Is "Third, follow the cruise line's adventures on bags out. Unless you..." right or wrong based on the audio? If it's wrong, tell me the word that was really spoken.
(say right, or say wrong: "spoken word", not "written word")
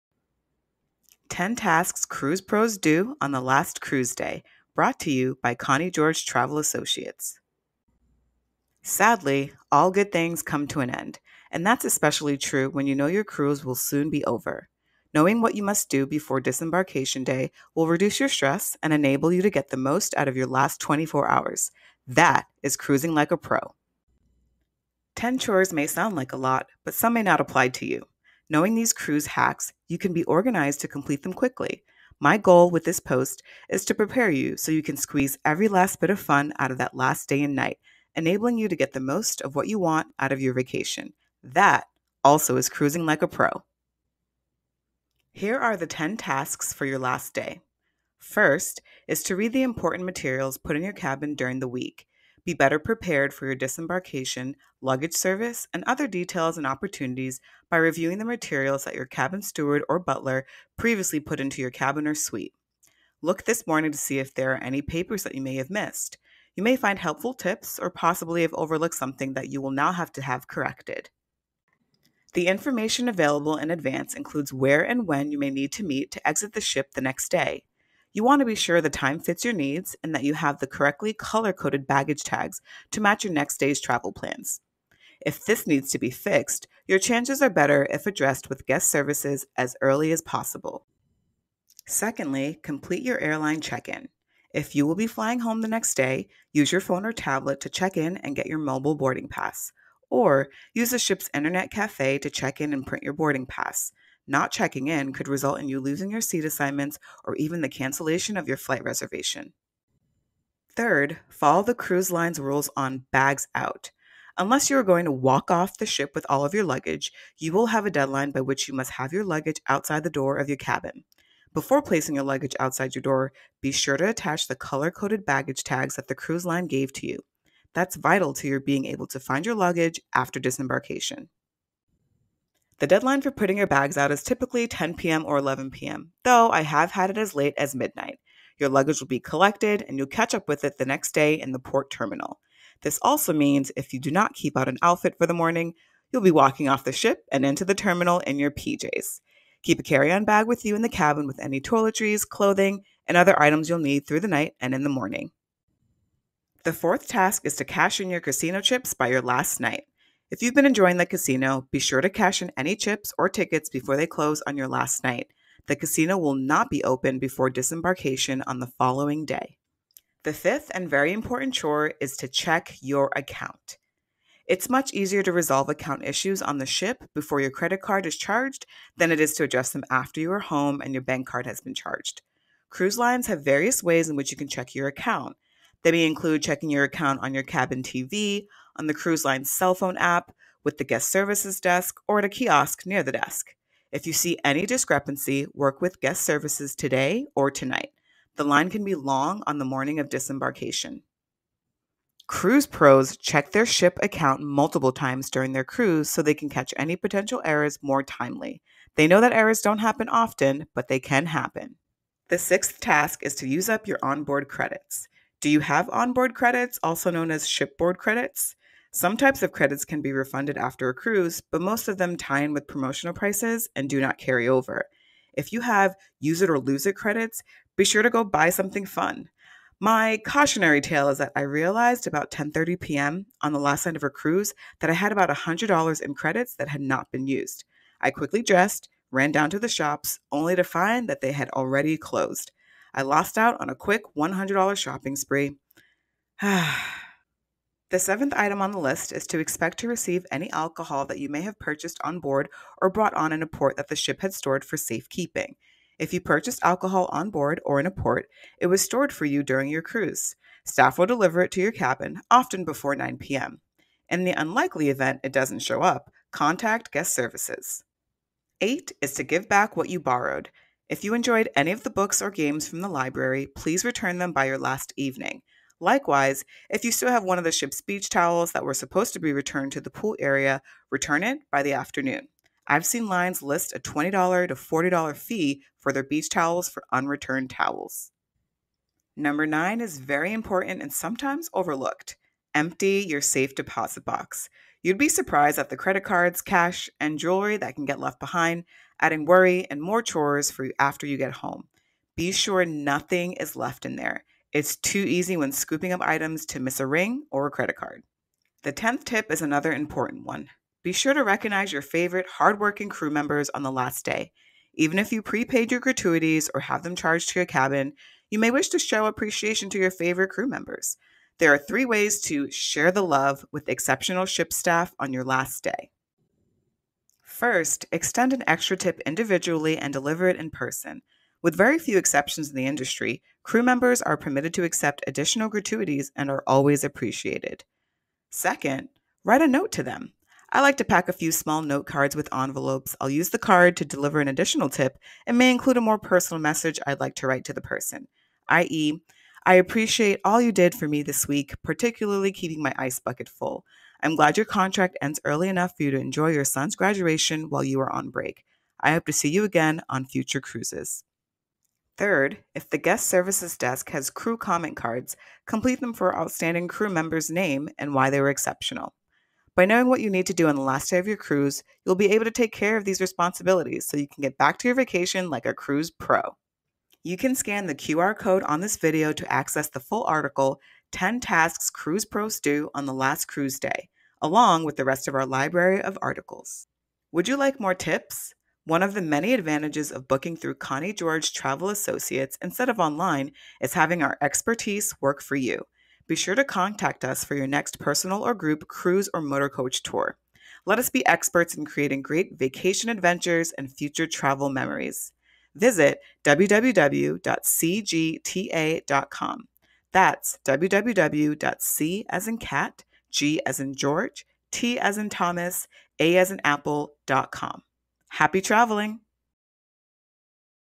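wrong: "rules", not "adventures".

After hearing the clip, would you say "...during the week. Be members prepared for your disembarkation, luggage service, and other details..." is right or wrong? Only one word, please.
wrong.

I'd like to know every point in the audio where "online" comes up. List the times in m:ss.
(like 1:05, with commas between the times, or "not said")
6:32.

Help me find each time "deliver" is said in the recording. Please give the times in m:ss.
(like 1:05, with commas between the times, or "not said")
4:21, 5:29, 5:43.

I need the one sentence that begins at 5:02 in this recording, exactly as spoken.
Be sure nothing is left in there.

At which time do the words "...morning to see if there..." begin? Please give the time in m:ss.
1:03.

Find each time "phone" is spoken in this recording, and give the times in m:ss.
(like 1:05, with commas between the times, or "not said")
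1:36, 3:09.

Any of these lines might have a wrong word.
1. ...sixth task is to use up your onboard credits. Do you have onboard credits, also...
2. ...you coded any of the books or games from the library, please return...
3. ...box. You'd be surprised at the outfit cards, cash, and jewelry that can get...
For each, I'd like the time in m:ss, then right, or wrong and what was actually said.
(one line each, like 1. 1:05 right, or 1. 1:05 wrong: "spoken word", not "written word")
1. 3:32 right
2. 4:31 wrong: "enjoyed", not "coded"
3. 4:54 wrong: "credit", not "outfit".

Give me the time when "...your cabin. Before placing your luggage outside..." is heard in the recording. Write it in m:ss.
2:00.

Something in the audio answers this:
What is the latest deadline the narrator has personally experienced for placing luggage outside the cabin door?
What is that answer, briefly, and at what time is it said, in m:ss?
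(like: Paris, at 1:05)
midnight, at 2:17.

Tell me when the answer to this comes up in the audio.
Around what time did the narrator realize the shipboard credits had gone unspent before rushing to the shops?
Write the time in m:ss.
3:52.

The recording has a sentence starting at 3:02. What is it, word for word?
Cruise lines have various ways in which you can check your account.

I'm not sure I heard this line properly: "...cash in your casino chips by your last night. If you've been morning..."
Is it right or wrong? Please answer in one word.
wrong.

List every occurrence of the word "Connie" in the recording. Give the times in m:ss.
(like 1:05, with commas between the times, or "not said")
0:05, 6:30.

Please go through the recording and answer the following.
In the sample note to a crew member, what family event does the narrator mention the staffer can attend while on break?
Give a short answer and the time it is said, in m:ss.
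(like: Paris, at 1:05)
son's graduation, at 5:56.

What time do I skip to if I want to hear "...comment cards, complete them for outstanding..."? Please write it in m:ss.
6:04.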